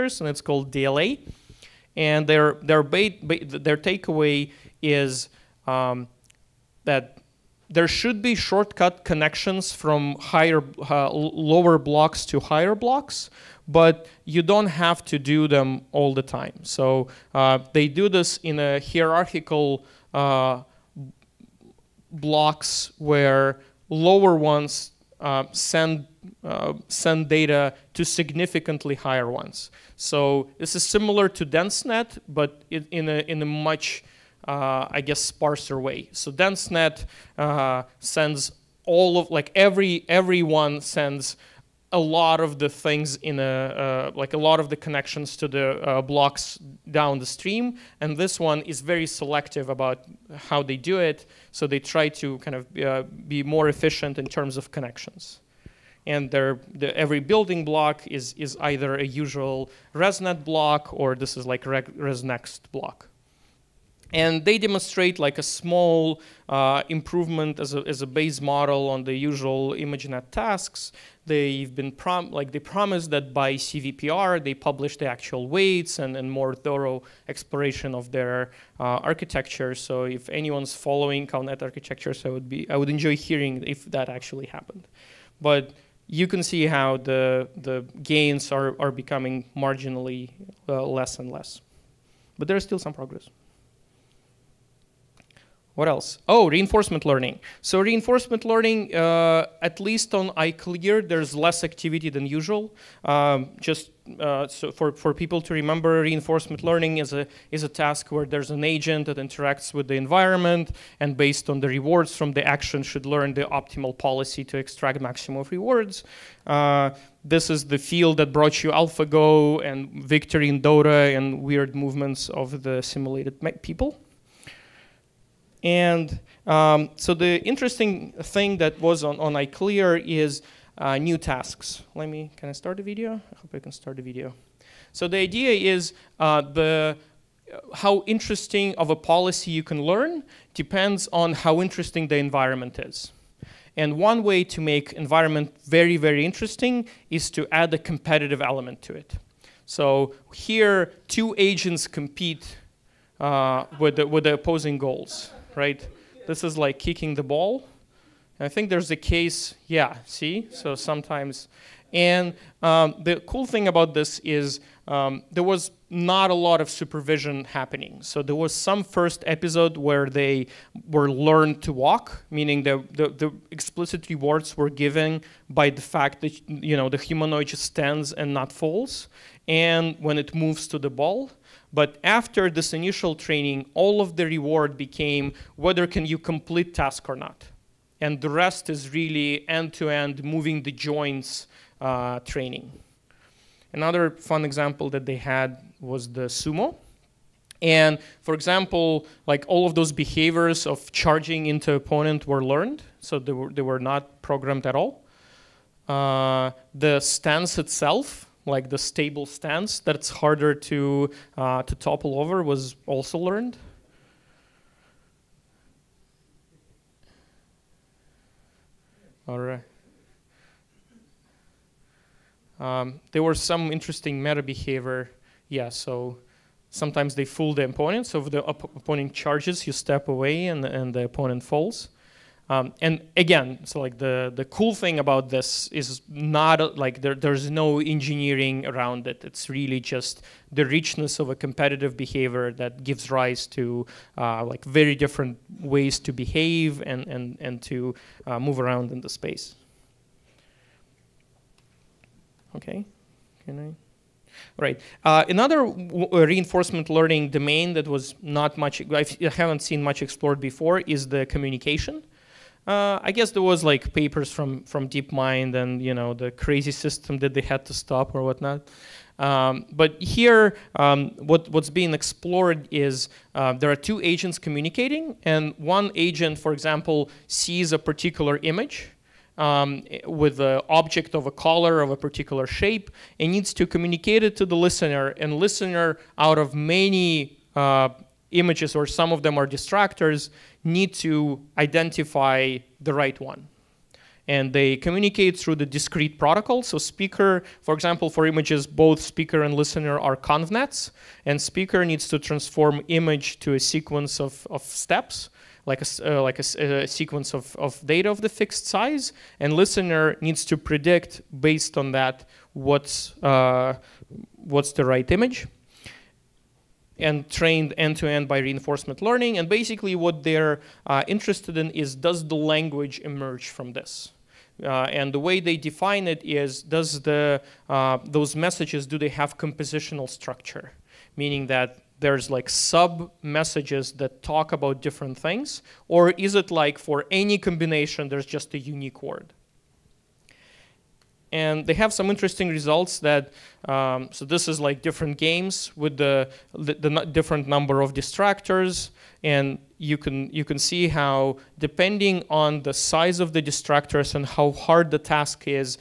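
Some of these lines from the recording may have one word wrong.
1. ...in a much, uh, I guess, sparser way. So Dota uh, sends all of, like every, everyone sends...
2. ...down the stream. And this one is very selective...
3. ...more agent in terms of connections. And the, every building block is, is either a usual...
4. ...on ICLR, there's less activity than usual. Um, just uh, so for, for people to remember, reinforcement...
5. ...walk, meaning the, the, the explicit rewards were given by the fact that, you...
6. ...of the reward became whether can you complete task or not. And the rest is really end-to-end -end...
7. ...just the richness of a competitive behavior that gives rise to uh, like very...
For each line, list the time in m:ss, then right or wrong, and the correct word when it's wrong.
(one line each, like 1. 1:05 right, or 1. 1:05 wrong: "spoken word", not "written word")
1. 0:33 wrong: "DenseNet", not "Dota"
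2. 0:46 right
3. 0:53 wrong: "efficient", not "agent"
4. 1:40 right
5. 2:51 right
6. 3:04 right
7. 3:59 right.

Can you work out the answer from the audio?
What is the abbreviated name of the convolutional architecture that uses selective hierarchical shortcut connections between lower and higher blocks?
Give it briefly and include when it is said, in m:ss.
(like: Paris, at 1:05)
DLA, at 0:00.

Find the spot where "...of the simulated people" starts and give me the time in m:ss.
2:02.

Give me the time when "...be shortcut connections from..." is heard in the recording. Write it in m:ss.
0:08.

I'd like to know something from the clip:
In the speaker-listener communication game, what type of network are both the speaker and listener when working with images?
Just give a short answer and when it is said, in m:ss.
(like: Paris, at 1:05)
convnets, at 5:00.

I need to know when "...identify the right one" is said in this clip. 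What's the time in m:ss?
4:51.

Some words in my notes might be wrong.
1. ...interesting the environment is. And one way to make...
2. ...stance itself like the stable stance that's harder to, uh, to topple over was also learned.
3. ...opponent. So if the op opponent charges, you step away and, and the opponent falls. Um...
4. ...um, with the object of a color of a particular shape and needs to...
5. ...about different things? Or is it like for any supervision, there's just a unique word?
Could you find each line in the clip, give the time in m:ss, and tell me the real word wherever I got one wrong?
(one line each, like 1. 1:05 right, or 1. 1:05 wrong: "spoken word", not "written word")
1. 2:21 right
2. 3:27 right
3. 3:47 right
4. 4:39 right
5. 5:34 wrong: "combination", not "supervision".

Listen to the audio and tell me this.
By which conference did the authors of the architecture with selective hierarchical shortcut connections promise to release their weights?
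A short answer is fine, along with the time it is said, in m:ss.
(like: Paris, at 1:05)
CVPR, at 1:13.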